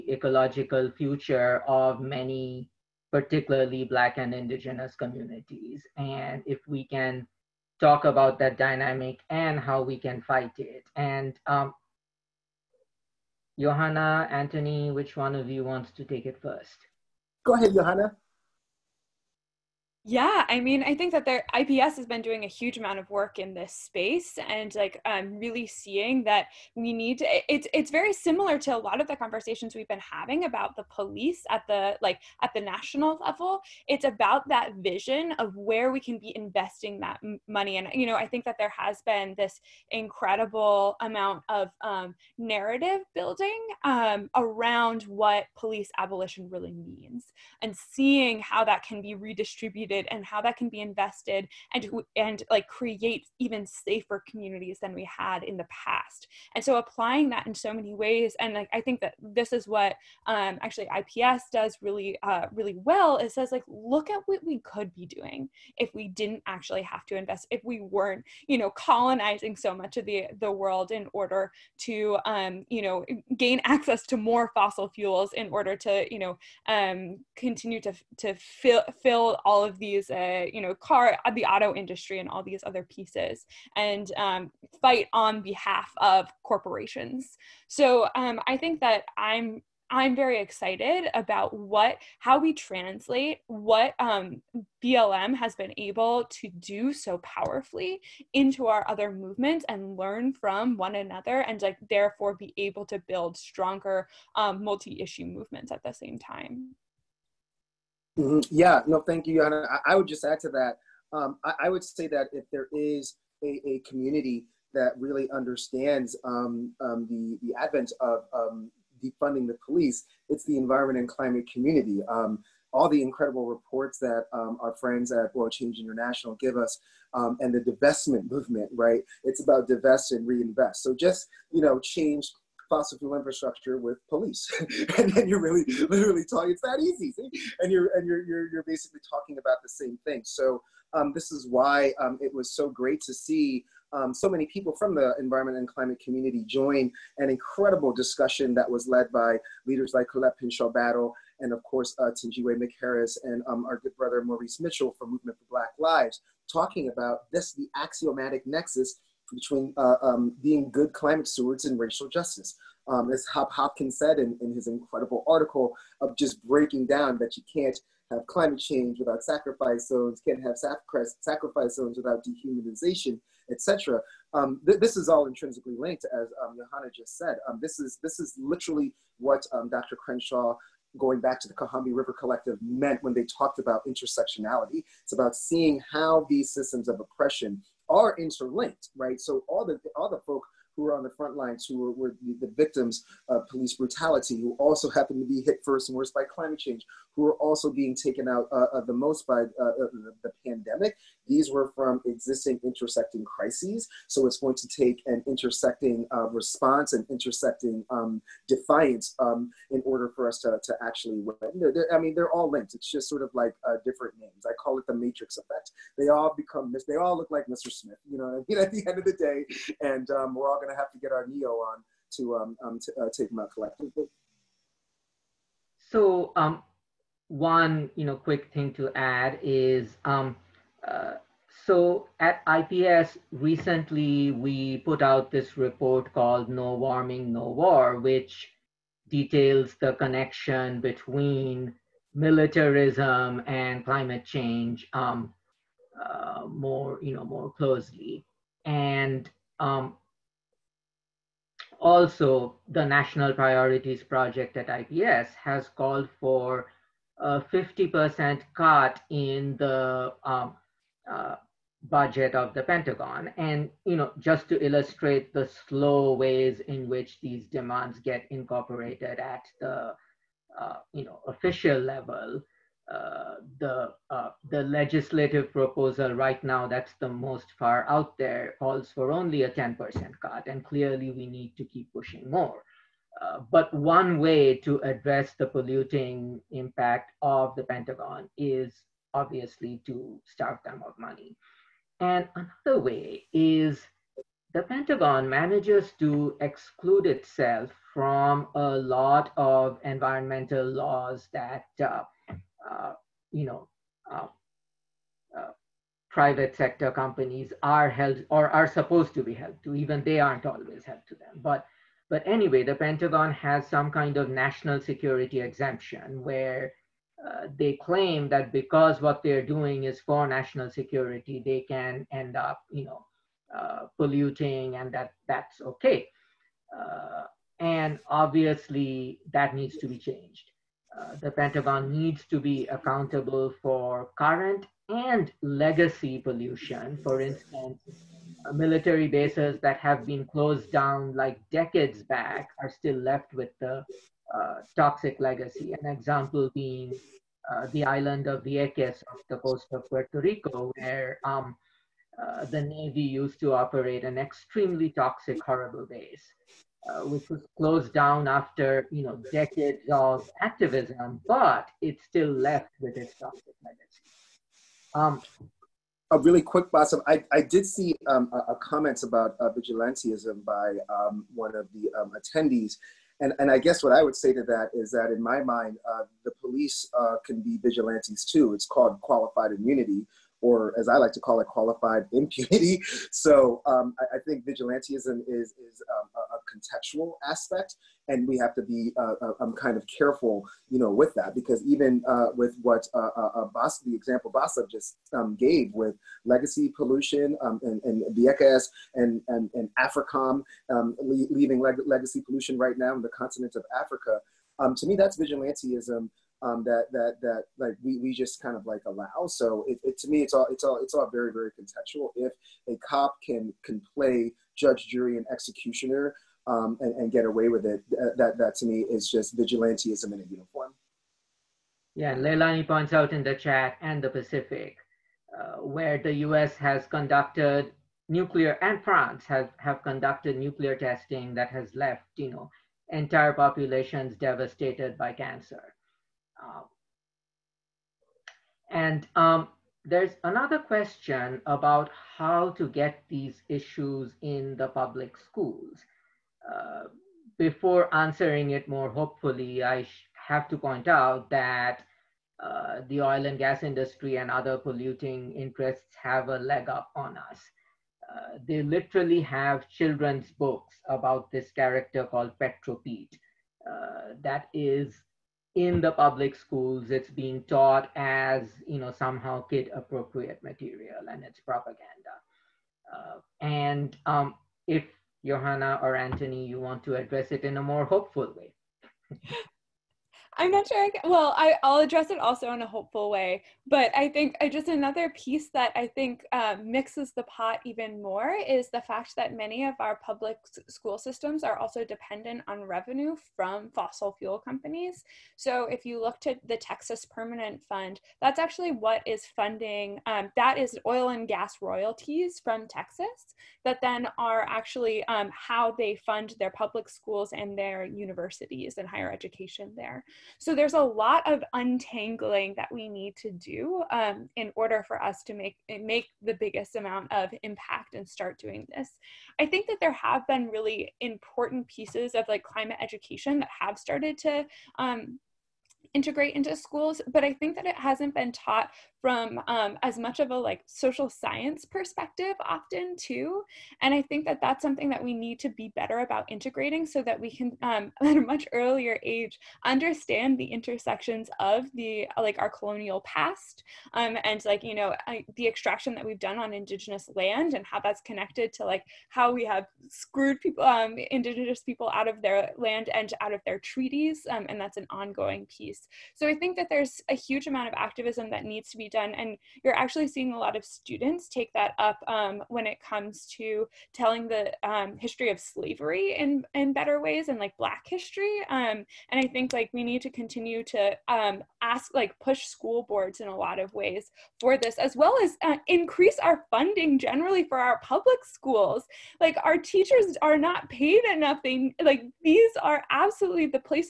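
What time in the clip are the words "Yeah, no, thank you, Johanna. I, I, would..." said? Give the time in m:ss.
1:48.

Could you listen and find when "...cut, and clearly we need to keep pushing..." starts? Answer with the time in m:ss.
4:40.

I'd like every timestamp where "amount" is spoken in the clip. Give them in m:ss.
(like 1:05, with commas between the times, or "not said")
0:22, 0:40, 8:36, 9:17.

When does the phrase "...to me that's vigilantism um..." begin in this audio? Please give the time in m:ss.
6:44.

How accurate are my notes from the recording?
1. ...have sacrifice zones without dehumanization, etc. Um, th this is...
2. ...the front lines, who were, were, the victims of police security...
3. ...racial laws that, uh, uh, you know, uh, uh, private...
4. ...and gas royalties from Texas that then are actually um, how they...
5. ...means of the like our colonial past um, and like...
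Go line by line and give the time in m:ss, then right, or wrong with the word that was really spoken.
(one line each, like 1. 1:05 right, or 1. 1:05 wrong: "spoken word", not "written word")
1. 2:50 right
2. 3:11 wrong: "brutality", not "security"
3. 4:59 wrong: "environmental", not "racial"
4. 8:21 right
5. 9:00 wrong: "intersections", not "means".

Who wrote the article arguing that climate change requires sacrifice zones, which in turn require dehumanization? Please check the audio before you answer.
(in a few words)
Hop Hopkins.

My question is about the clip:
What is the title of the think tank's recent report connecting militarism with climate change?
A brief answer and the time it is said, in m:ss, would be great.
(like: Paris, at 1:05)
No Warming, No War, at 3:56.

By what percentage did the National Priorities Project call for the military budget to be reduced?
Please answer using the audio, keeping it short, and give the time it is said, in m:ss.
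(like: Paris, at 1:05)
50%, at 4:17.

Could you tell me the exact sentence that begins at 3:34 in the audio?
I call it the matrix effect.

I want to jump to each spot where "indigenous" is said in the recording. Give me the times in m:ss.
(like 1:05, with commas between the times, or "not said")
0:04, 9:06, 9:11.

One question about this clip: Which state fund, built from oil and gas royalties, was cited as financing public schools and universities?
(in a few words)
Texas Permanent Fund.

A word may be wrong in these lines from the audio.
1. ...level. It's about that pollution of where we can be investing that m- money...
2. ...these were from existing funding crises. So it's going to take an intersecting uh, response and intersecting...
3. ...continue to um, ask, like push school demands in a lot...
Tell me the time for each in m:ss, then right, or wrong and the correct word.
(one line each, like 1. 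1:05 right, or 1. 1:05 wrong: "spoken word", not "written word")
1. 0:33 wrong: "vision", not "pollution"
2. 3:21 wrong: "intersecting", not "funding"
3. 9:30 wrong: "boards", not "demands".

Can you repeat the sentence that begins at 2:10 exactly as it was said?
So just you know, change fossil fuel infrastructure with police.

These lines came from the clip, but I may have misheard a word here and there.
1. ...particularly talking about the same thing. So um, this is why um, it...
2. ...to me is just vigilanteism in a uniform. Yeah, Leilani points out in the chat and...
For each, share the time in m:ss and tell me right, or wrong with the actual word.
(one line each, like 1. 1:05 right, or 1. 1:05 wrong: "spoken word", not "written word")
1. 2:18 wrong: "basically", not "particularly"
2. 6:58 right.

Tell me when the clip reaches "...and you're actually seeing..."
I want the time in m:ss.
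9:19.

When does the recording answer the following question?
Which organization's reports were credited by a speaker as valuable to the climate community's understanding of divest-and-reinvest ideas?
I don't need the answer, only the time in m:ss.
2:05.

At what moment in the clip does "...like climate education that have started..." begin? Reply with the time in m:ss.
8:42.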